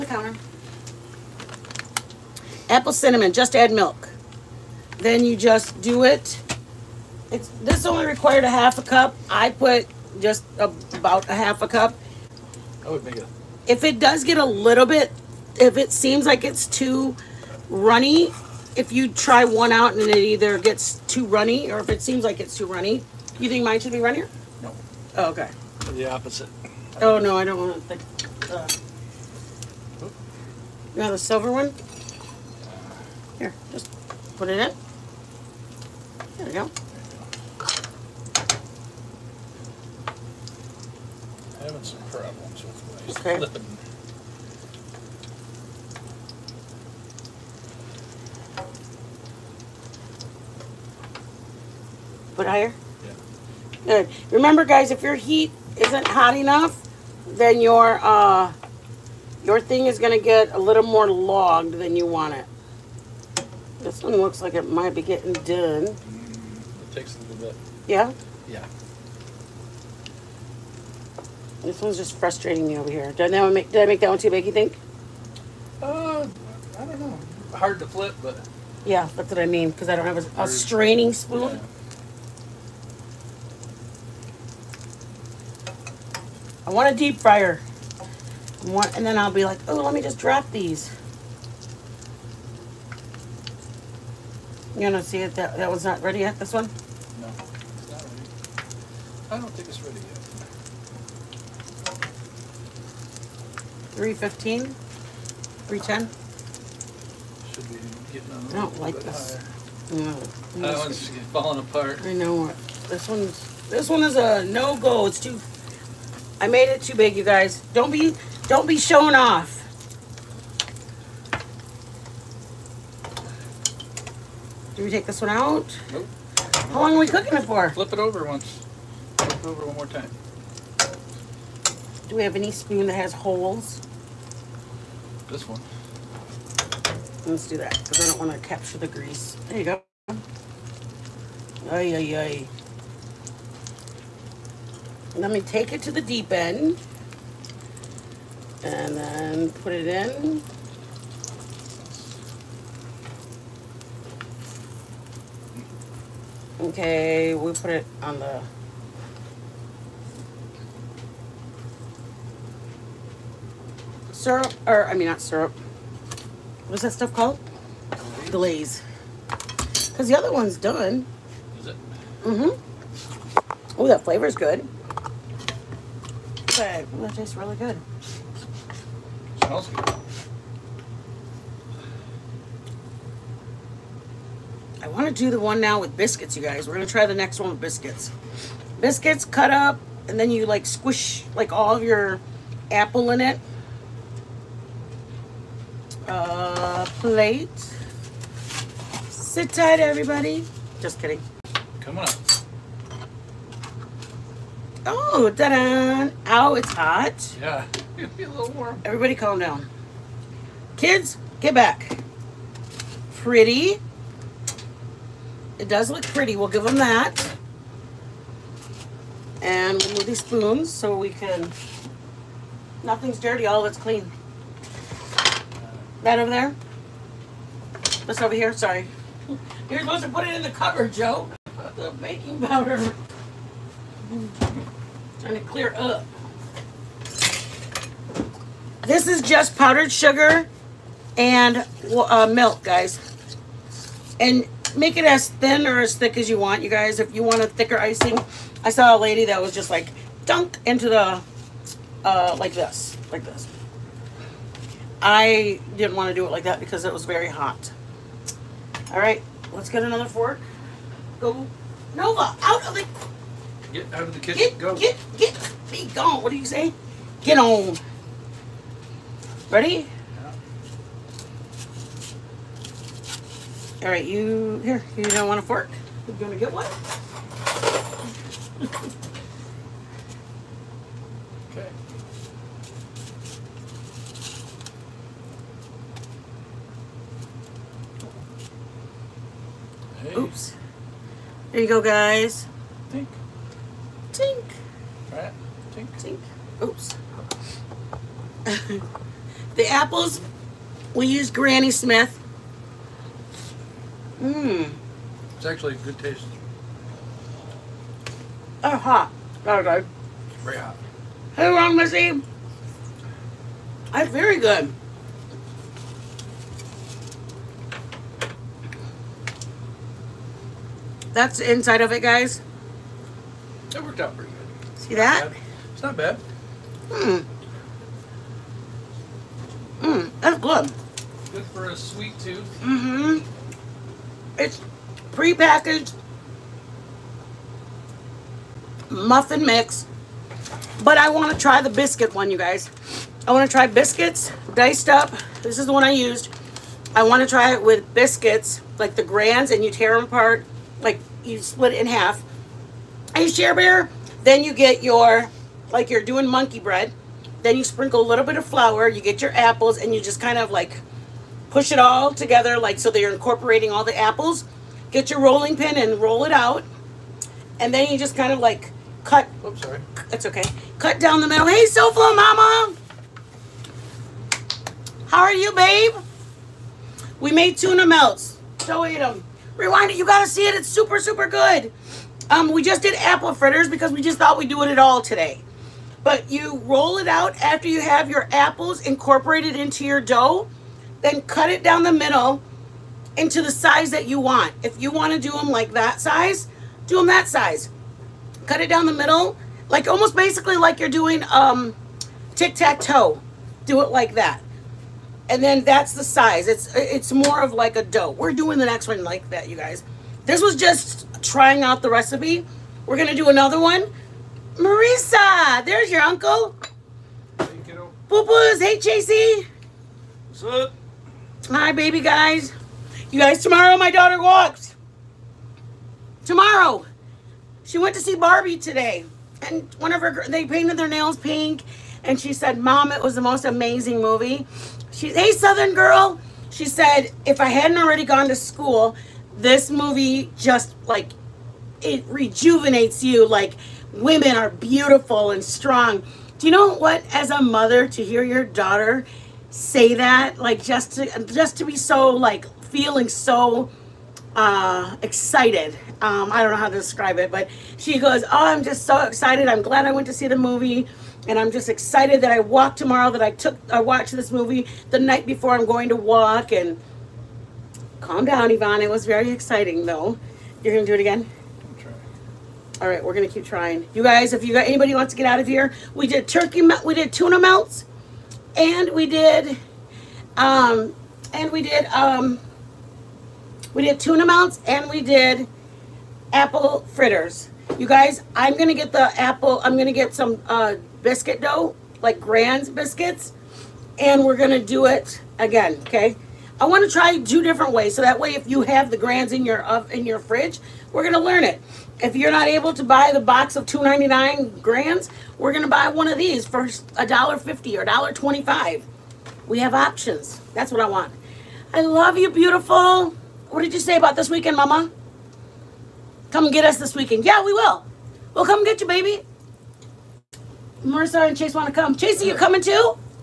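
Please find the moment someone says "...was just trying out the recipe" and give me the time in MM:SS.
06:50.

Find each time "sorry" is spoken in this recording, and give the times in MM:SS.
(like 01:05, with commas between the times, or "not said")
03:48, 06:09.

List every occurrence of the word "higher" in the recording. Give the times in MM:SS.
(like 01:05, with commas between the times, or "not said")
00:52, 01:49.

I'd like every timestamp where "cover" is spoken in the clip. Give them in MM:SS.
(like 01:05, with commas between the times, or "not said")
03:50.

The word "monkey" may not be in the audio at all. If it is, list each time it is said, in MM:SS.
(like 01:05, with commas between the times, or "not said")
05:56.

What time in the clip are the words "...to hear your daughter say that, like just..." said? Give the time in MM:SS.
07:27.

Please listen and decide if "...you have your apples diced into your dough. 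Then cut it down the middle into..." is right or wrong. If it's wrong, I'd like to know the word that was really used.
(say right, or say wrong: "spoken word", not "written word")
wrong: "incorporated", not "diced".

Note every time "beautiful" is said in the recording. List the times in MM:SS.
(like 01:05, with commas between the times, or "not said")
07:24, 08:32.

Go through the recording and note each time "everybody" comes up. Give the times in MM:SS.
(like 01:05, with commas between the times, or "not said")
03:19, 03:28.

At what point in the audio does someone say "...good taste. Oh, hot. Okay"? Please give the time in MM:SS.
05:05.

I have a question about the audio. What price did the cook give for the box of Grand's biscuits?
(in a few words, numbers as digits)
$2.99.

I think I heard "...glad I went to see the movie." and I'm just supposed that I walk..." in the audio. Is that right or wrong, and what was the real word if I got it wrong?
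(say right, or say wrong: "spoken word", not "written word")
wrong: "excited", not "supposed".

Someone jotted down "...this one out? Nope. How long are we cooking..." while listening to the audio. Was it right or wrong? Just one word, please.
right.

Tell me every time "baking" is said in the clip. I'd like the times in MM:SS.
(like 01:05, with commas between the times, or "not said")
03:52.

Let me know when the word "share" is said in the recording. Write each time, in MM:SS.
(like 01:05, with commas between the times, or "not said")
05:53.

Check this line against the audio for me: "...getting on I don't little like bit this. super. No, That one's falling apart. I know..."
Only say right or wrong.
wrong.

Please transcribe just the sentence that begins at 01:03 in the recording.
This one looks like it might be getting done.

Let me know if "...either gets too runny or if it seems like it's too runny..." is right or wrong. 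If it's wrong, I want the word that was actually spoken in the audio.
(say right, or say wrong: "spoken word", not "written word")
right.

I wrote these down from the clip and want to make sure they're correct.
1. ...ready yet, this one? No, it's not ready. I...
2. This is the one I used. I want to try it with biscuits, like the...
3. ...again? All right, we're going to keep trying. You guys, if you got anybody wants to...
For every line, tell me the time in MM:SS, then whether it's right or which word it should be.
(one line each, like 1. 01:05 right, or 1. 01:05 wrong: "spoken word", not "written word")
1. 01:36 right
2. 05:45 right
3. 07:51 right.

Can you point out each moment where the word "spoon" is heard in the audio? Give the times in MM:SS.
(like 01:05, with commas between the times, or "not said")
01:21, 02:12, 03:40.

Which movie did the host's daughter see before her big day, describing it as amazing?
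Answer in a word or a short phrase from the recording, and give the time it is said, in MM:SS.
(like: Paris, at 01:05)
Barbie, at 07:08.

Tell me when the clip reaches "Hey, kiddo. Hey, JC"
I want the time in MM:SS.
06:57.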